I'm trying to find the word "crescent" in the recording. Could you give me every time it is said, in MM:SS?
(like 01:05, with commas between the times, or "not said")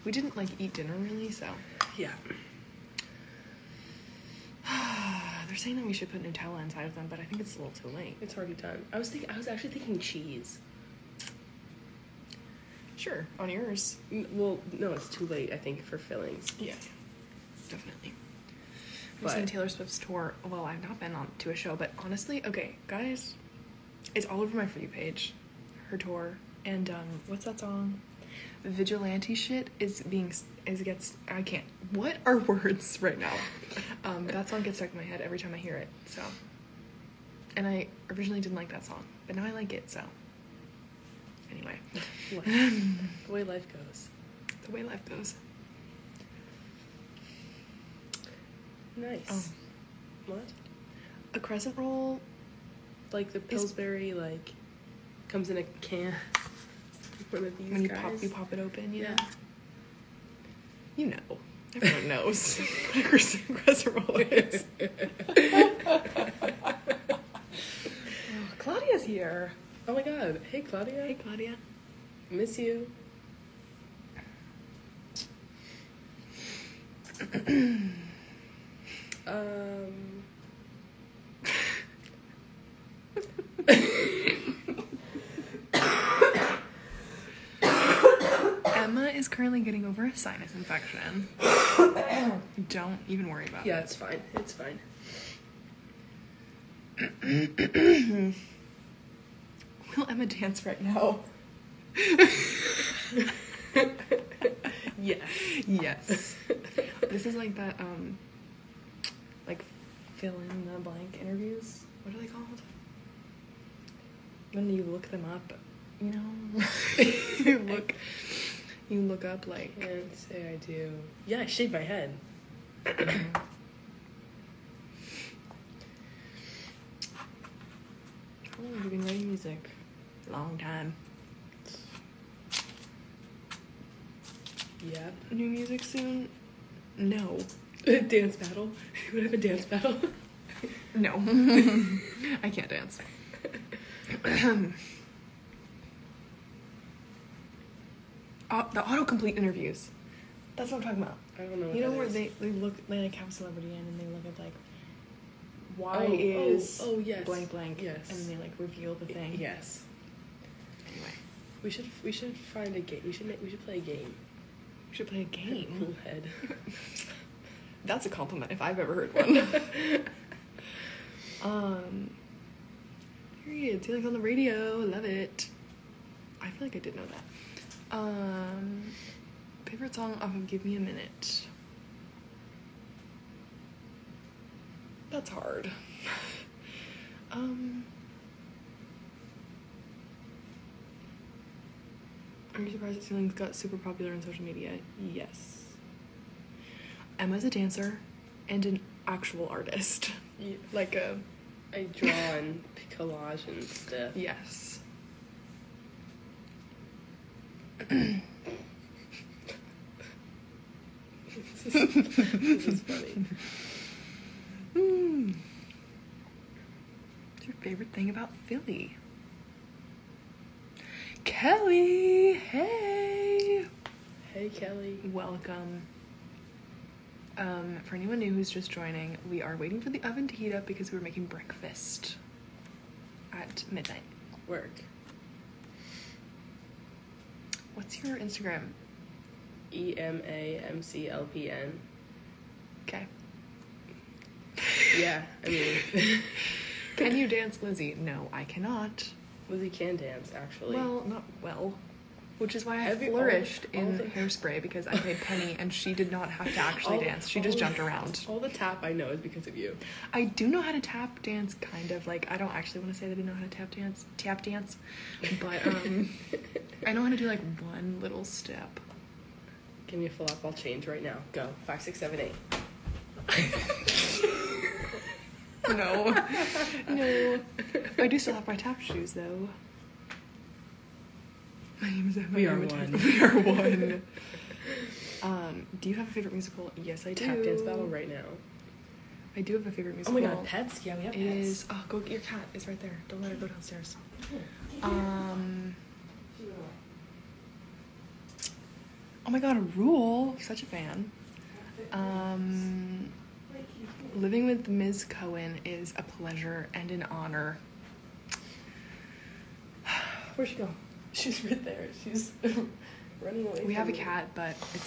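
00:51, 01:03.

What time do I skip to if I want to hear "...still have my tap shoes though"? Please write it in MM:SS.
04:38.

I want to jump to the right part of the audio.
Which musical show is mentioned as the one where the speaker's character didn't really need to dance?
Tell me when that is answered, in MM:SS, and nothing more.
04:14.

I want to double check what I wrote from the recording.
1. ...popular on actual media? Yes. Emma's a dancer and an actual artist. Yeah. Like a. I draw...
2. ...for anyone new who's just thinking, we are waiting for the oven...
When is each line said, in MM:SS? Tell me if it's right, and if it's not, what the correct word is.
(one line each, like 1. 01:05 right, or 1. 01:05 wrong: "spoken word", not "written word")
1. 03:13 wrong: "social", not "actual"
2. 03:47 wrong: "joining", not "thinking".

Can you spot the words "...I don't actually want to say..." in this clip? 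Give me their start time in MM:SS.
04:22.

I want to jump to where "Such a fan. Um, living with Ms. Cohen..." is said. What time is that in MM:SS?
05:00.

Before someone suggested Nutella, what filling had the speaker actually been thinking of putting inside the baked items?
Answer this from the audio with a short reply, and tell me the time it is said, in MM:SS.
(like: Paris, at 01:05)
cheese, at 00:09.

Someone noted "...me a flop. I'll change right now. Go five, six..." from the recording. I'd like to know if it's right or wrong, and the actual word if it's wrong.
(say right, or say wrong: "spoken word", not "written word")
right.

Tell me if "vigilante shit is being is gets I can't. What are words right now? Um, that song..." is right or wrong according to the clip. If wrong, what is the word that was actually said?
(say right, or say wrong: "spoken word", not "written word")
right.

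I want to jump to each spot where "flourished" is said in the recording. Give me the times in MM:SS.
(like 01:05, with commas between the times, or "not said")
04:13.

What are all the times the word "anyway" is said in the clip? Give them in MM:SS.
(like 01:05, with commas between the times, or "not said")
00:41, 02:40.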